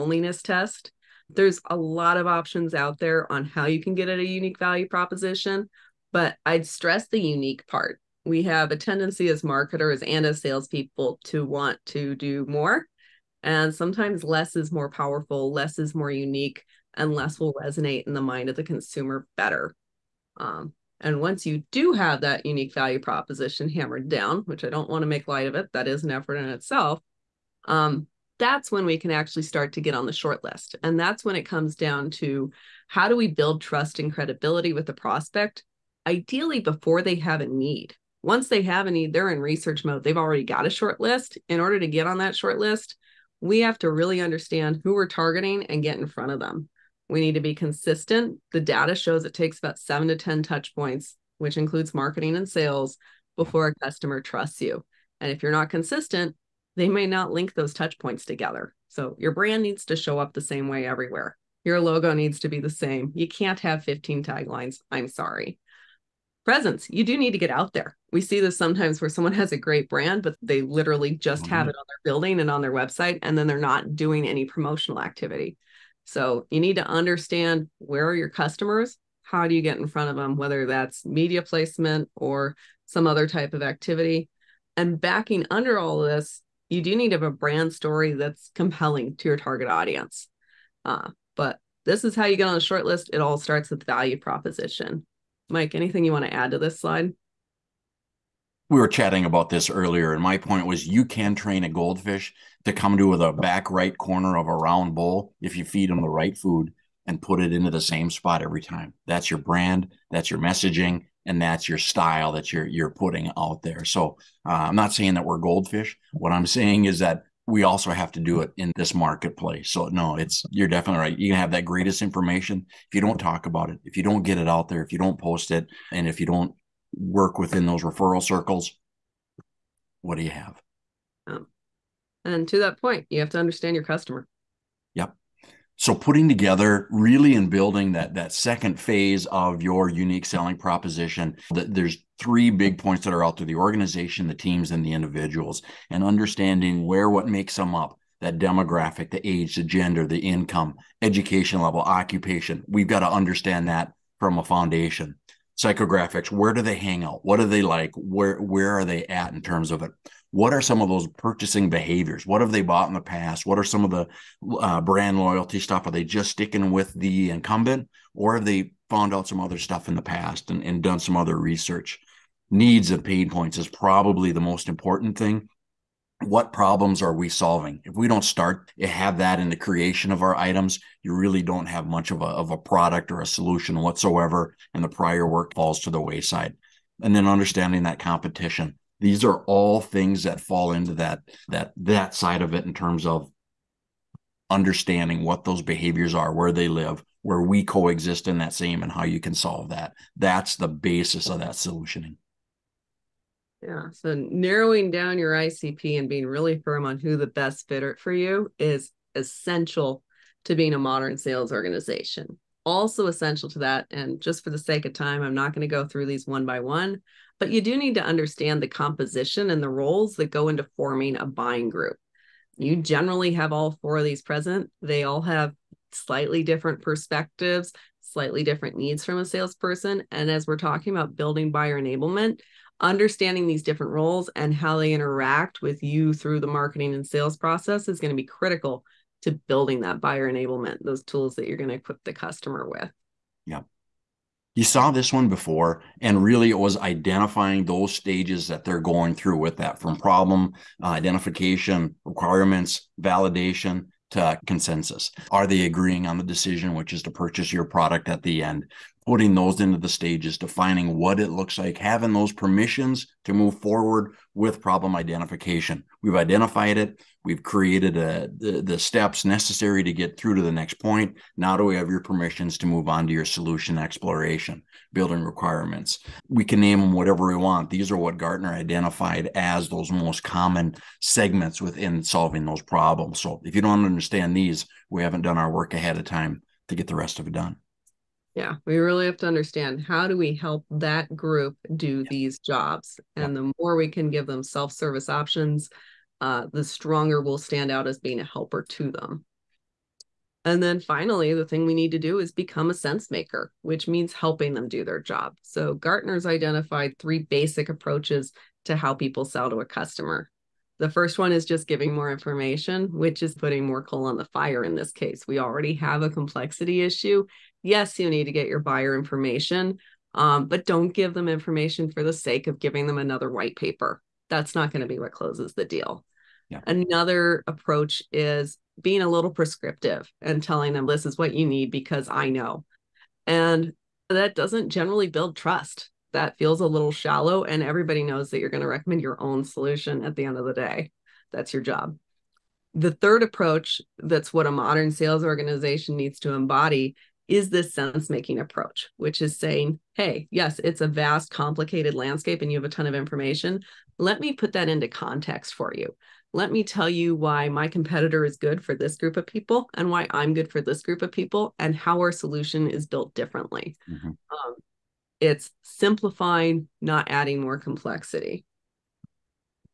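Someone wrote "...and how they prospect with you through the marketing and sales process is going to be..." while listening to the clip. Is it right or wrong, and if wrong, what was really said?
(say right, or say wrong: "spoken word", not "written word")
wrong: "interact", not "prospect".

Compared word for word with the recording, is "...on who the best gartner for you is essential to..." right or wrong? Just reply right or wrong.
wrong.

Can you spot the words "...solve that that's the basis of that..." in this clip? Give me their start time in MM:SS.
03:19.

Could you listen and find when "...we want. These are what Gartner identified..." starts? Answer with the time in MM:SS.
04:37.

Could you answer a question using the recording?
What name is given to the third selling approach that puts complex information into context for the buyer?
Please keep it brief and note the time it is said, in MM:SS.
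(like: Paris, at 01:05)
Sense making, at 05:47.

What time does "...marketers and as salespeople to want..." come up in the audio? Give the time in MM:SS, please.
00:09.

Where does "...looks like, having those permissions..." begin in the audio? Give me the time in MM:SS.
04:21.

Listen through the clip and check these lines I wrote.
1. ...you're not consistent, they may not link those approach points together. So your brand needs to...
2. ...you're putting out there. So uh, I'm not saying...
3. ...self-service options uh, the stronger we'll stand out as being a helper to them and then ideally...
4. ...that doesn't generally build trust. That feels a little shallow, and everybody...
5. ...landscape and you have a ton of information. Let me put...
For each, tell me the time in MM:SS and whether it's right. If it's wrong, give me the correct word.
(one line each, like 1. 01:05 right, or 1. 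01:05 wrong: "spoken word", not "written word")
1. 00:55 wrong: "touch", not "approach"
2. 01:52 right
3. 04:54 wrong: "finally", not "ideally"
4. 05:34 right
5. 05:51 right.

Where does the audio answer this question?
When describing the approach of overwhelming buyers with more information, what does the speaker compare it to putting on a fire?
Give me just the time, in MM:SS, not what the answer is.
05:13.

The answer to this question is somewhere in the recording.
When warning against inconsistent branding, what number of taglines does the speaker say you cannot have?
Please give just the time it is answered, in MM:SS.
01:03.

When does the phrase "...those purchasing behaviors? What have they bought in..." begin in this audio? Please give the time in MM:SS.
02:40.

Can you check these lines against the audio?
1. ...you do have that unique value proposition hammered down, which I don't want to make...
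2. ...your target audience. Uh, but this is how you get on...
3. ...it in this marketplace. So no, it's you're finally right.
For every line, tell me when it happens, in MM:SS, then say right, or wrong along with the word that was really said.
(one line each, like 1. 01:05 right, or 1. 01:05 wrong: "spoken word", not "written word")
1. 00:21 right
2. 01:29 right
3. 01:58 wrong: "definitely", not "finally".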